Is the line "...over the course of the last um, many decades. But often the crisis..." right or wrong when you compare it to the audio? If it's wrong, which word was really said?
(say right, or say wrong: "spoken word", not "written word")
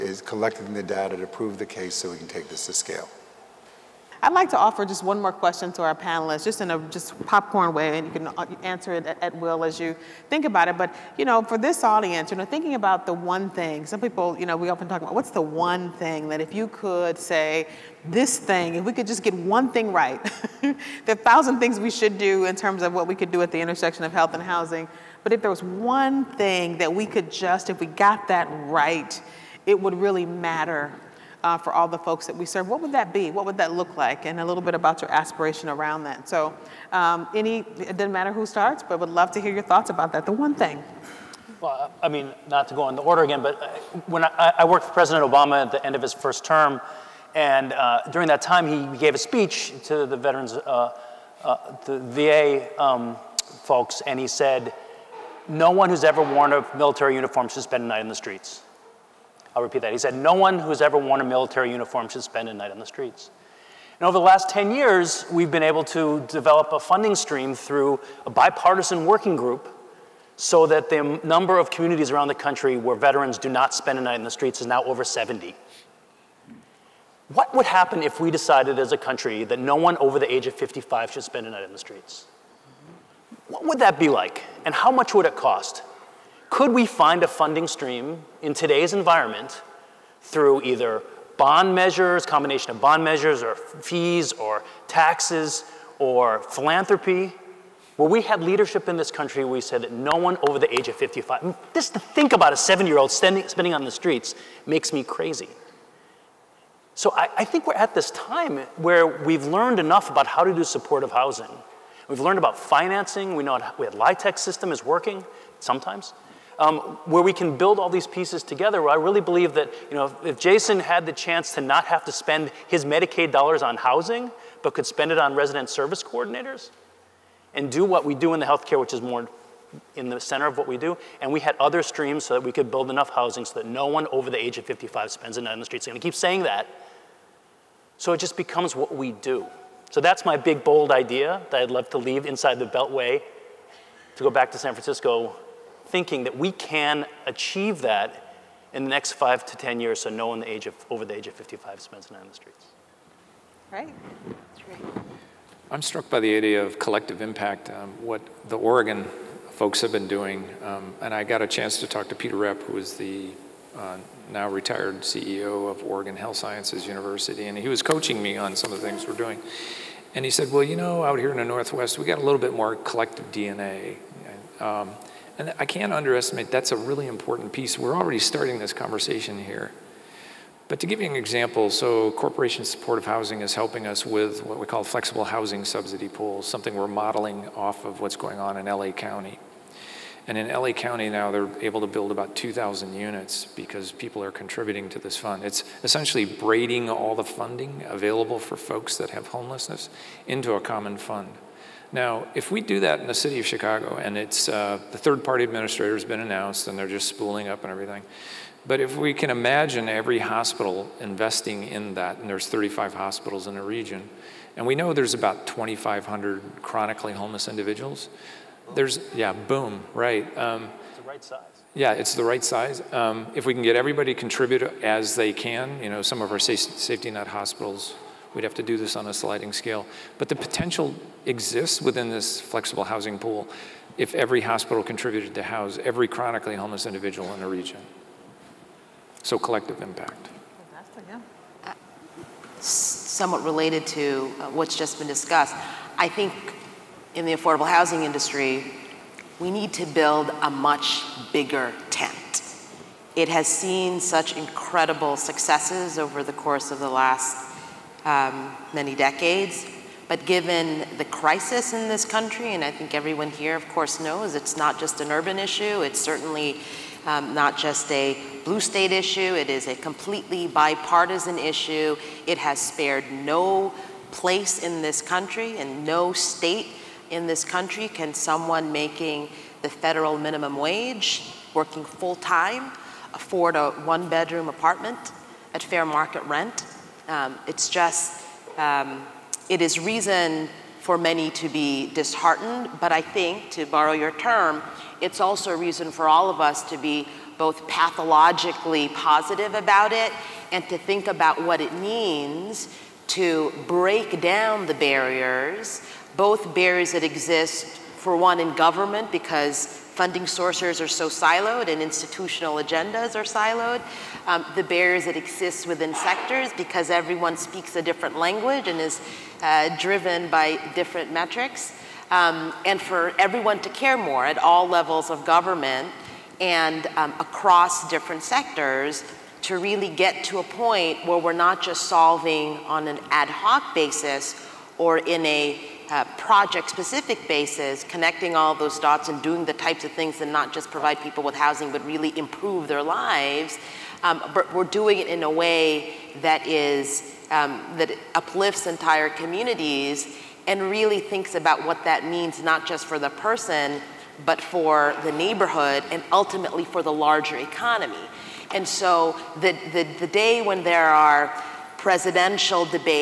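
wrong: "given", not "often".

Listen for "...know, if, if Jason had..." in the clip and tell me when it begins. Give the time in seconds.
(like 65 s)
119 s.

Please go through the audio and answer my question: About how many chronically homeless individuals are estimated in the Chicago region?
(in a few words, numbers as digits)
2,500.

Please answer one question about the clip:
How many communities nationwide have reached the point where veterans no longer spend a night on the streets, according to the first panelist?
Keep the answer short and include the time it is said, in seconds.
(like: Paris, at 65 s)
over 70, at 74 s.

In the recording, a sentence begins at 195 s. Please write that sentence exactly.
It's essentially braiding all the funding available for folks that have homelessness into a common fund.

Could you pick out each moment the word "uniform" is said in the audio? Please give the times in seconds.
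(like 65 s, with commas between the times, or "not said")
57 s, 61 s.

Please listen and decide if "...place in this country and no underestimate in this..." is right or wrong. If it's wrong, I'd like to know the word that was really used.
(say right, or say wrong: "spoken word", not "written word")
wrong: "state", not "underestimate".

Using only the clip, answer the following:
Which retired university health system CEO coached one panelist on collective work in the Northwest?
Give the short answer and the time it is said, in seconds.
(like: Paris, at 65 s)
Peter Rapp, at 162 s.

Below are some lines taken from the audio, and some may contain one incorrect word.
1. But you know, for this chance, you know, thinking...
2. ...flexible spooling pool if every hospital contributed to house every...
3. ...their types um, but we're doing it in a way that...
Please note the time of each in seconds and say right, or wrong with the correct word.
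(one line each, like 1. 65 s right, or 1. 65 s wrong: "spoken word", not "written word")
1. 10 s wrong: "audience", not "chance"
2. 232 s wrong: "housing", not "spooling"
3. 342 s wrong: "lives", not "types".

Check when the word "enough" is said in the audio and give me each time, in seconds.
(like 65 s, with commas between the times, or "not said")
109 s, 132 s.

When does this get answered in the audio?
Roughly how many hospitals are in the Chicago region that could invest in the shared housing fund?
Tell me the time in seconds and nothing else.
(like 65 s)
212 s.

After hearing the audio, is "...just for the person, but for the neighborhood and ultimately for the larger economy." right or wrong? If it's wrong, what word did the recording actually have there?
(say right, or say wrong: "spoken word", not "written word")
right.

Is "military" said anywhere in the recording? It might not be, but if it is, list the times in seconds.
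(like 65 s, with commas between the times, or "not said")
56 s, 61 s.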